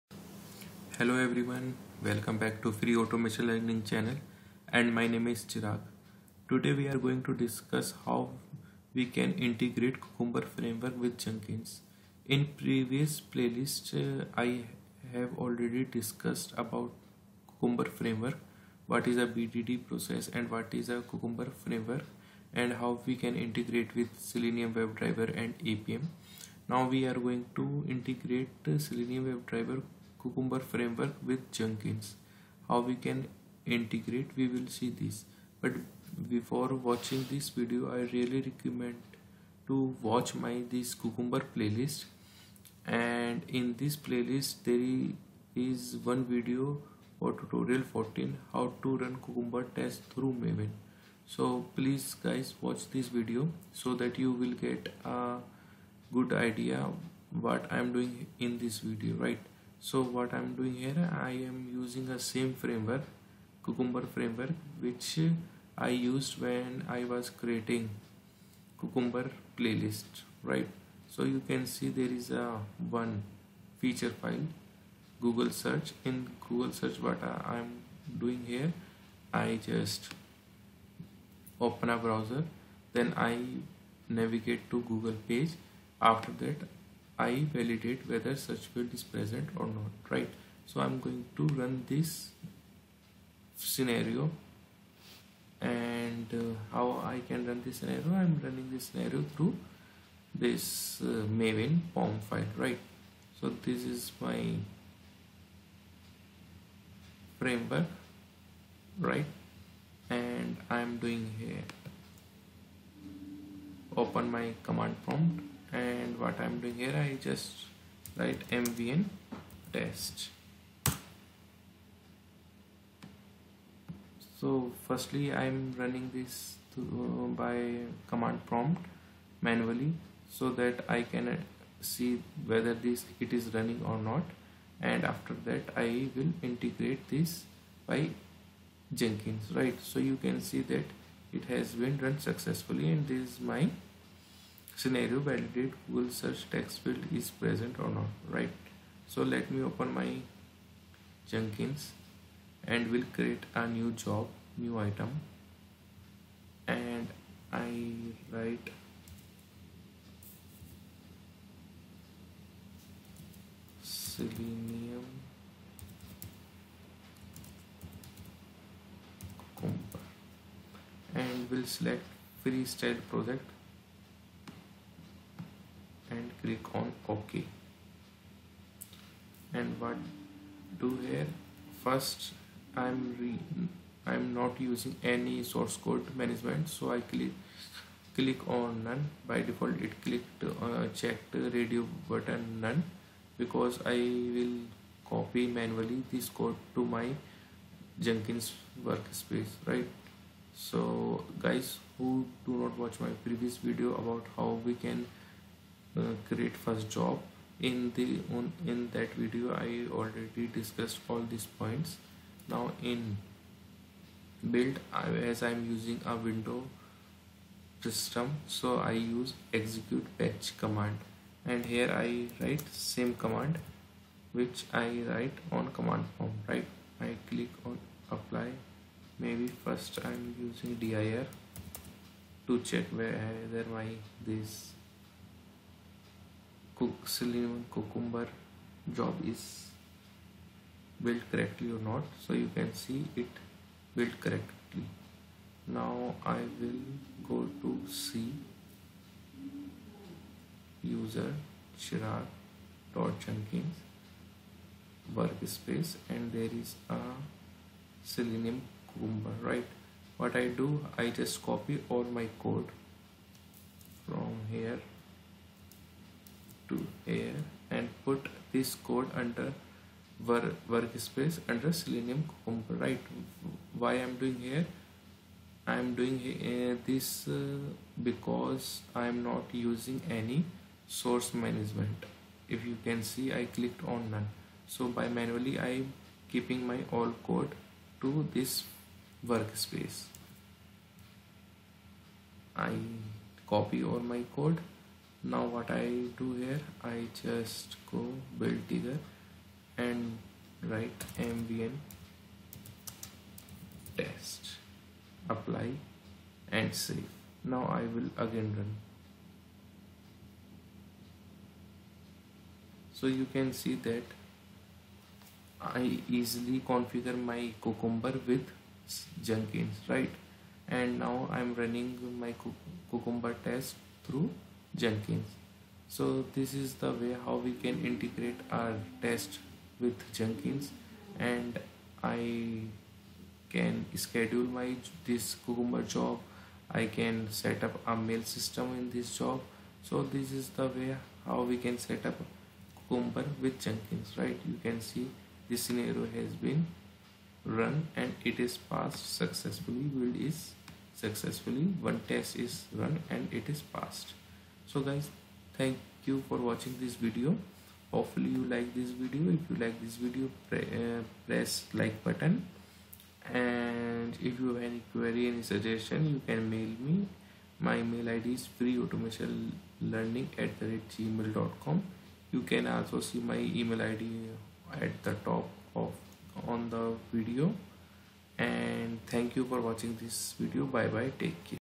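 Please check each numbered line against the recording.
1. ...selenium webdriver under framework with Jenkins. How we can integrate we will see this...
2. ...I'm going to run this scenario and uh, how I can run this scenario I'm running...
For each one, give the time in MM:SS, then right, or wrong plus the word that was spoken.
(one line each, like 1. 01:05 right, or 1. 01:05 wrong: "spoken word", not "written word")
1. 00:28 wrong: "cucumber", not "under"
2. 01:30 right.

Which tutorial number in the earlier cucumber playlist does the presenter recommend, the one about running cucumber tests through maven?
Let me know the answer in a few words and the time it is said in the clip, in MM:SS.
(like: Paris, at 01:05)
14, at 00:47.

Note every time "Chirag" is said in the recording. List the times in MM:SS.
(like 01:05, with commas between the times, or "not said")
00:05, 04:11.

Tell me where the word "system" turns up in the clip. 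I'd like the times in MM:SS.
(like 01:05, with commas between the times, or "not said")
03:37, 05:38.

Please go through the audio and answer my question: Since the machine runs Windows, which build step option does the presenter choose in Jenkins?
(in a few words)
execute batch command.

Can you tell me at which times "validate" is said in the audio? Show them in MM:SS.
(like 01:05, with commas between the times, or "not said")
01:27, 02:25.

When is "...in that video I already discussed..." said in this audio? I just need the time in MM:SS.
03:28.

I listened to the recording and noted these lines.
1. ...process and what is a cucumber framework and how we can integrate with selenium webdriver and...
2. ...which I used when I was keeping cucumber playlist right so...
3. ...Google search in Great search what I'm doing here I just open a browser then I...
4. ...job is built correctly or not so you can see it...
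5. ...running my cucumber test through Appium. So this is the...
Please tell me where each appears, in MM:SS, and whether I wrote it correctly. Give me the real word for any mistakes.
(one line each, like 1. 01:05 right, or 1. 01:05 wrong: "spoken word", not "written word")
1. 00:19 right
2. 01:04 wrong: "creating", not "keeping"
3. 01:15 wrong: "Google", not "Great"
4. 03:58 right
5. 05:21 wrong: "Jenkins", not "Appium".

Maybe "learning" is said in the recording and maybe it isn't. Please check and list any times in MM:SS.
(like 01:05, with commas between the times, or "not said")
00:03, 06:09.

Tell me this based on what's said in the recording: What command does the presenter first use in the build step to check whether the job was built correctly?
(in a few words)
dir.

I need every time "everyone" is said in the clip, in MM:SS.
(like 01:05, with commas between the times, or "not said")
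00:01.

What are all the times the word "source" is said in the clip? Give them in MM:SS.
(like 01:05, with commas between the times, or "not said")
03:05, 04:40.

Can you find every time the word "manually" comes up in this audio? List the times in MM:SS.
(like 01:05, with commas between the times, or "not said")
02:09, 03:15, 04:45.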